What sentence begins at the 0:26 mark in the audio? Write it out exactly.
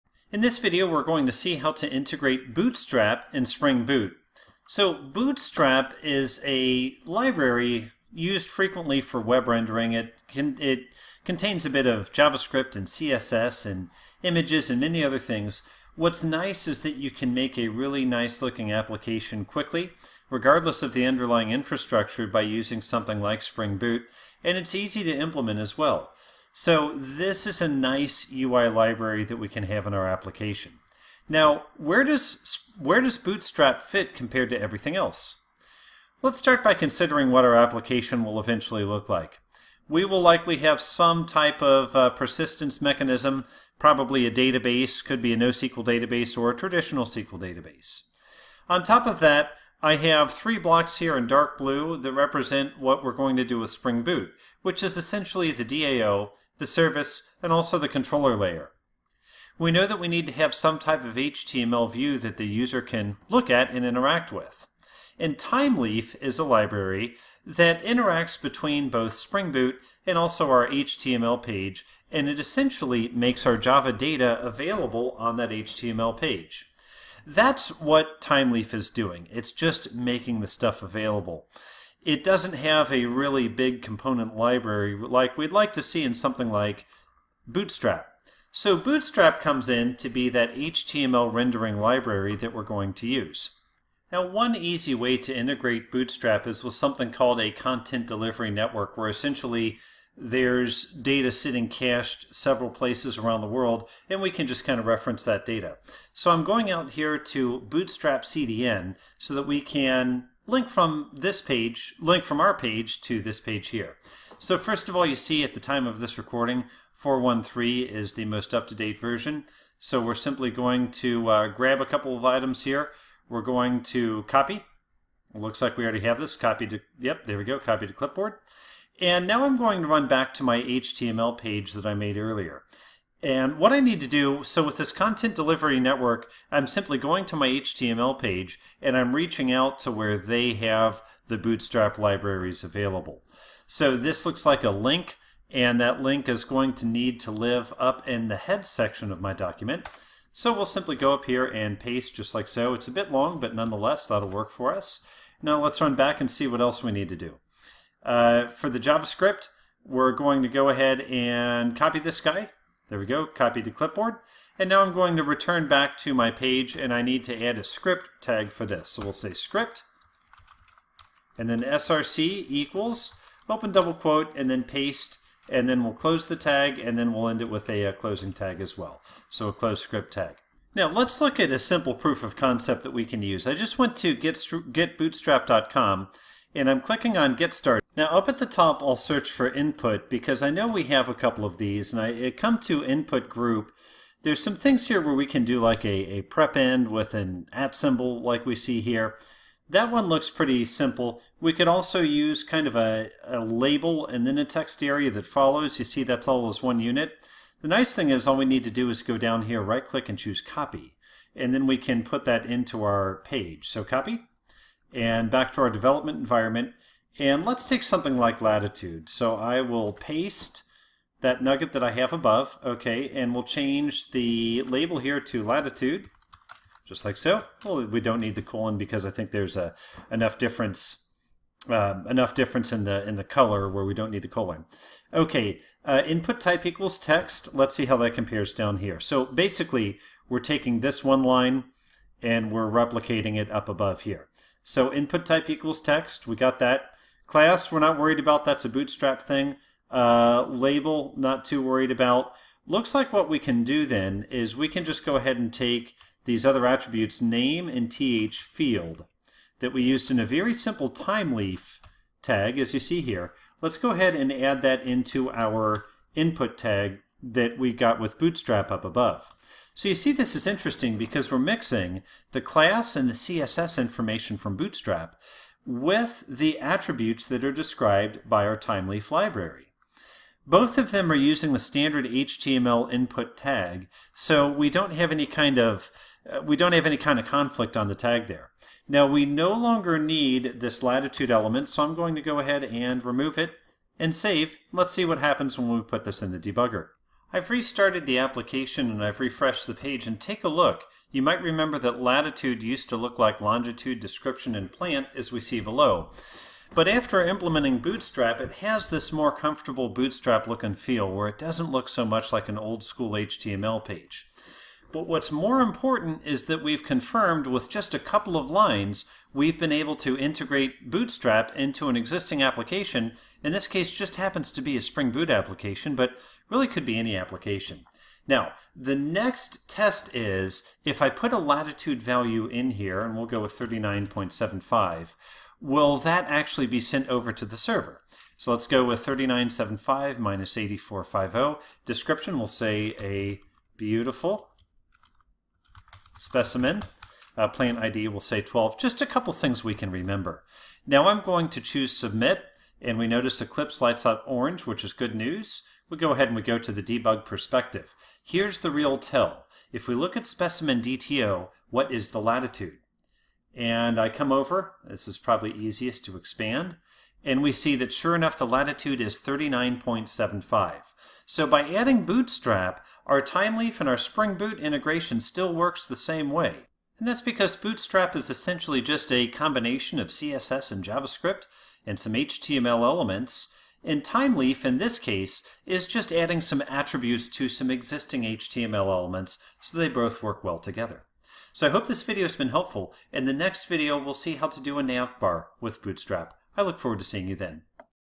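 So this is a nice UI library that we can have in our application.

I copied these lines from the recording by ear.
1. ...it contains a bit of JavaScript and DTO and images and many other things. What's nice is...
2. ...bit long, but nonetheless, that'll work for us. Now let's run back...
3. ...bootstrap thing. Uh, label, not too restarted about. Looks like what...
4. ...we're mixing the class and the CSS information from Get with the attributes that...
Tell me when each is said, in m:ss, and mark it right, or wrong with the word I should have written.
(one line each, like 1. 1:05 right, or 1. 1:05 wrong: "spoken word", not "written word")
1. 0:10 wrong: "CSS", not "DTO"
2. 2:32 right
3. 4:08 wrong: "worried", not "restarted"
4. 4:31 wrong: "Bootstrap", not "Get".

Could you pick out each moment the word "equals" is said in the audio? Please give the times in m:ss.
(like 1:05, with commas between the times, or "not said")
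2:52, 3:56, 4:05.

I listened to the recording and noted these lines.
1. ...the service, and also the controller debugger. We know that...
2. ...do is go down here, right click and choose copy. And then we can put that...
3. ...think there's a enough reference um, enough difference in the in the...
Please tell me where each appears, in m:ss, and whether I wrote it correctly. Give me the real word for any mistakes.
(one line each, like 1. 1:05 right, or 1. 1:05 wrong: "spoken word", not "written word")
1. 0:56 wrong: "layer", not "debugger"
2. 3:28 right
3. 3:49 wrong: "difference", not "reference".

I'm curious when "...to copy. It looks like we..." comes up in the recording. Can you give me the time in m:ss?
2:03.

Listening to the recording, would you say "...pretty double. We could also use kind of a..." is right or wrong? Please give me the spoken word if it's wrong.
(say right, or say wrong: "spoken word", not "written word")
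wrong: "simple", not "double".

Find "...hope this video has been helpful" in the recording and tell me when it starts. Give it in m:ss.
6:31.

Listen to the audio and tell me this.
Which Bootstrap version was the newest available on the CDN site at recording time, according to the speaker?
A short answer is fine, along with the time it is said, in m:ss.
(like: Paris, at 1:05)
4.1.3, at 1:56.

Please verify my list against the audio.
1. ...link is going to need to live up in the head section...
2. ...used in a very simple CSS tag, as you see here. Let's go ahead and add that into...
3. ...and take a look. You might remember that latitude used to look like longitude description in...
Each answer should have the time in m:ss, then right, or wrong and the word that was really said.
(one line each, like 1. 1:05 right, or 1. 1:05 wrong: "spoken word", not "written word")
1. 2:26 right
2. 4:19 wrong: "Thymeleaf", not "CSS"
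3. 5:00 right.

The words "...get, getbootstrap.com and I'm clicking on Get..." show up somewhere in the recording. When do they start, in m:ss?
3:04.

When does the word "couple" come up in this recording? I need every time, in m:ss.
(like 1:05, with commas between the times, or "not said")
2:01, 3:11, 5:17, 5:49.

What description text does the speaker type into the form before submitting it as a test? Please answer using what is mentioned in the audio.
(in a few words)
a beautiful specimen.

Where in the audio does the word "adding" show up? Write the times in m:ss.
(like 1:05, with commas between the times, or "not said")
6:11, 6:26.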